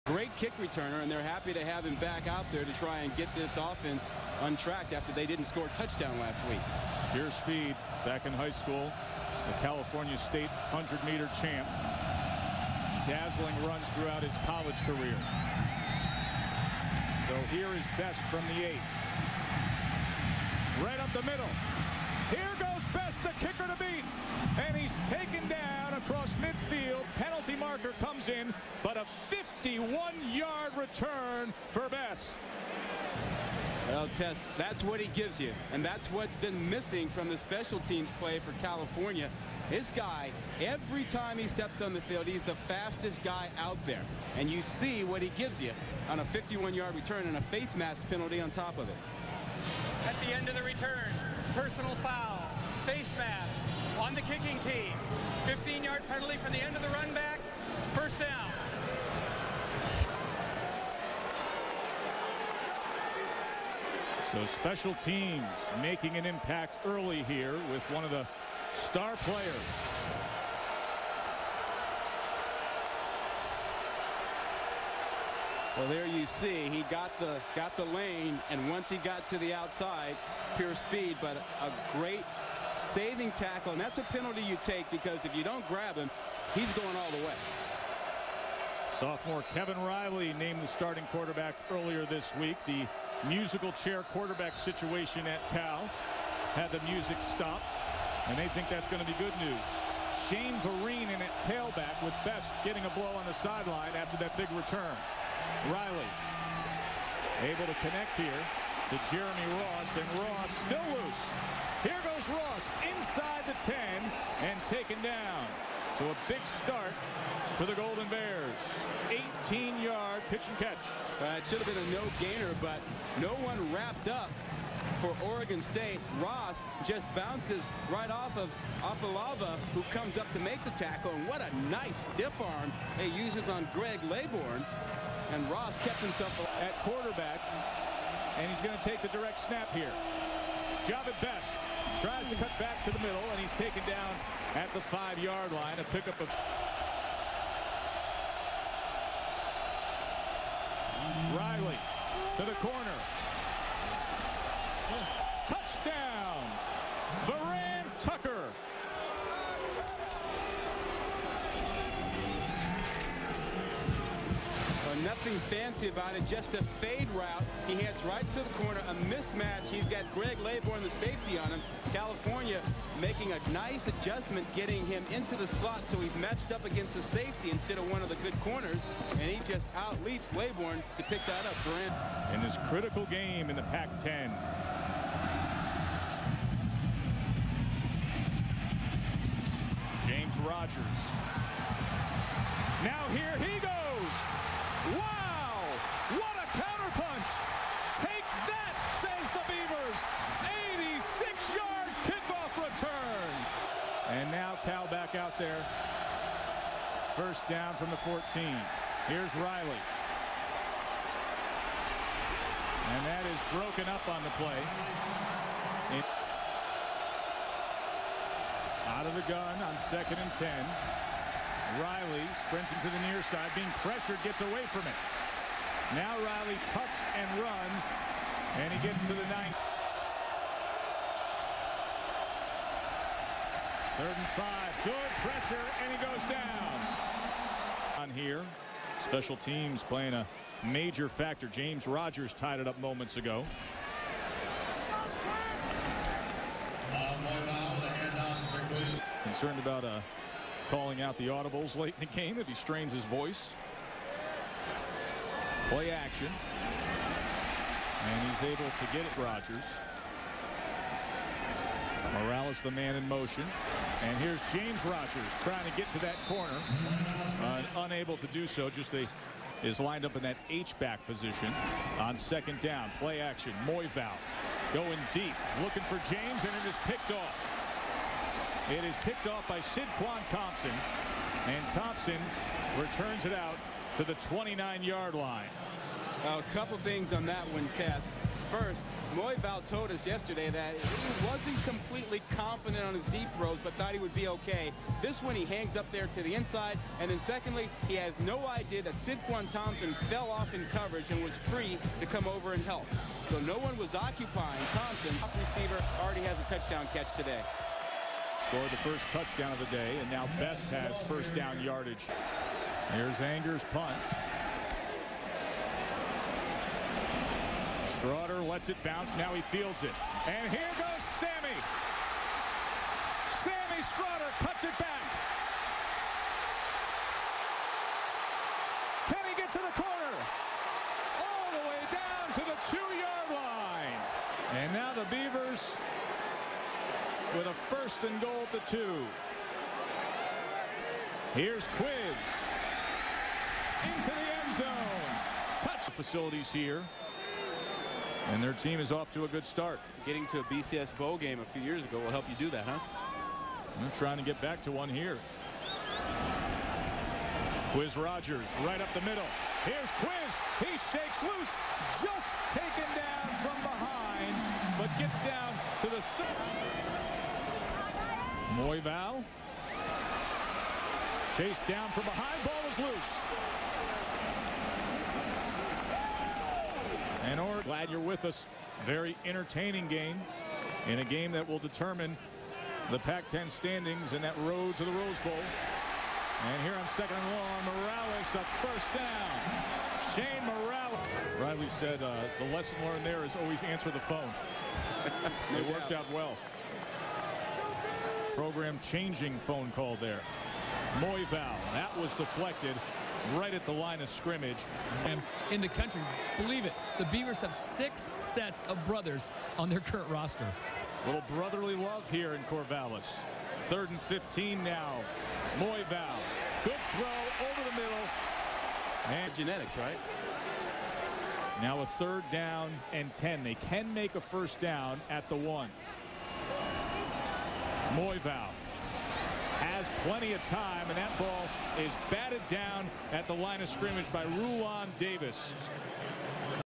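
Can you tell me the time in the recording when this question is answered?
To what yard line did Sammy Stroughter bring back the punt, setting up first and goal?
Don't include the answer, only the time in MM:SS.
05:32.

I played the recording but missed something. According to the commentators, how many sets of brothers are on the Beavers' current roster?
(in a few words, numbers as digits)
6.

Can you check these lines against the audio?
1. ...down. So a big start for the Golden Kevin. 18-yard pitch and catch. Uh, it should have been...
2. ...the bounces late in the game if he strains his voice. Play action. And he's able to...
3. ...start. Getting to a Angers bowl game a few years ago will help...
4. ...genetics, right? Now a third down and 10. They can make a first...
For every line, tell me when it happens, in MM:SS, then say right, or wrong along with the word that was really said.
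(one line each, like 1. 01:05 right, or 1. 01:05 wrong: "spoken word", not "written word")
1. 01:55 wrong: "Bears", not "Kevin"
2. 04:11 wrong: "audibles", not "bounces"
3. 05:49 wrong: "BCS", not "Angers"
4. 06:59 right.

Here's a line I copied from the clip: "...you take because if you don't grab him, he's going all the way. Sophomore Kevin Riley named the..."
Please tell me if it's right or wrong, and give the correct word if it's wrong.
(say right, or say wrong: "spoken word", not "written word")
right.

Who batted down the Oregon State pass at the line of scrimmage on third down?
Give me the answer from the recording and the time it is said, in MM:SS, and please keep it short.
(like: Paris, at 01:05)
Rulon Davis, at 07:14.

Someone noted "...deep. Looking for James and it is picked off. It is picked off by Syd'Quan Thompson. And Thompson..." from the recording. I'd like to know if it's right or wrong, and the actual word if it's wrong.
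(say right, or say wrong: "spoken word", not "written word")
right.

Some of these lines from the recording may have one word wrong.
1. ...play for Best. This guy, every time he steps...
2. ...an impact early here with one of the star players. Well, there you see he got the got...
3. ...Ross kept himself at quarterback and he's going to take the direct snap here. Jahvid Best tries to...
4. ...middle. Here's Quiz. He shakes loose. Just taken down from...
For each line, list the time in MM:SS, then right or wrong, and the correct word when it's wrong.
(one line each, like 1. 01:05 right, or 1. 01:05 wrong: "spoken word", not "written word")
1. 00:38 wrong: "California", not "Best"
2. 01:06 right
3. 02:15 right
4. 05:59 right.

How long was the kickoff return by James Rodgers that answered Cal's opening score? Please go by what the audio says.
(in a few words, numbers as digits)
86 yards.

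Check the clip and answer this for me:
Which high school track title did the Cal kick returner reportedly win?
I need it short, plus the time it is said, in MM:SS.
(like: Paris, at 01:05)
California State 100-meter champ, at 00:09.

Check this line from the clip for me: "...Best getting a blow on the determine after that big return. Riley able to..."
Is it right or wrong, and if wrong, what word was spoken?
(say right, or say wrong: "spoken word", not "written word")
wrong: "sideline", not "determine".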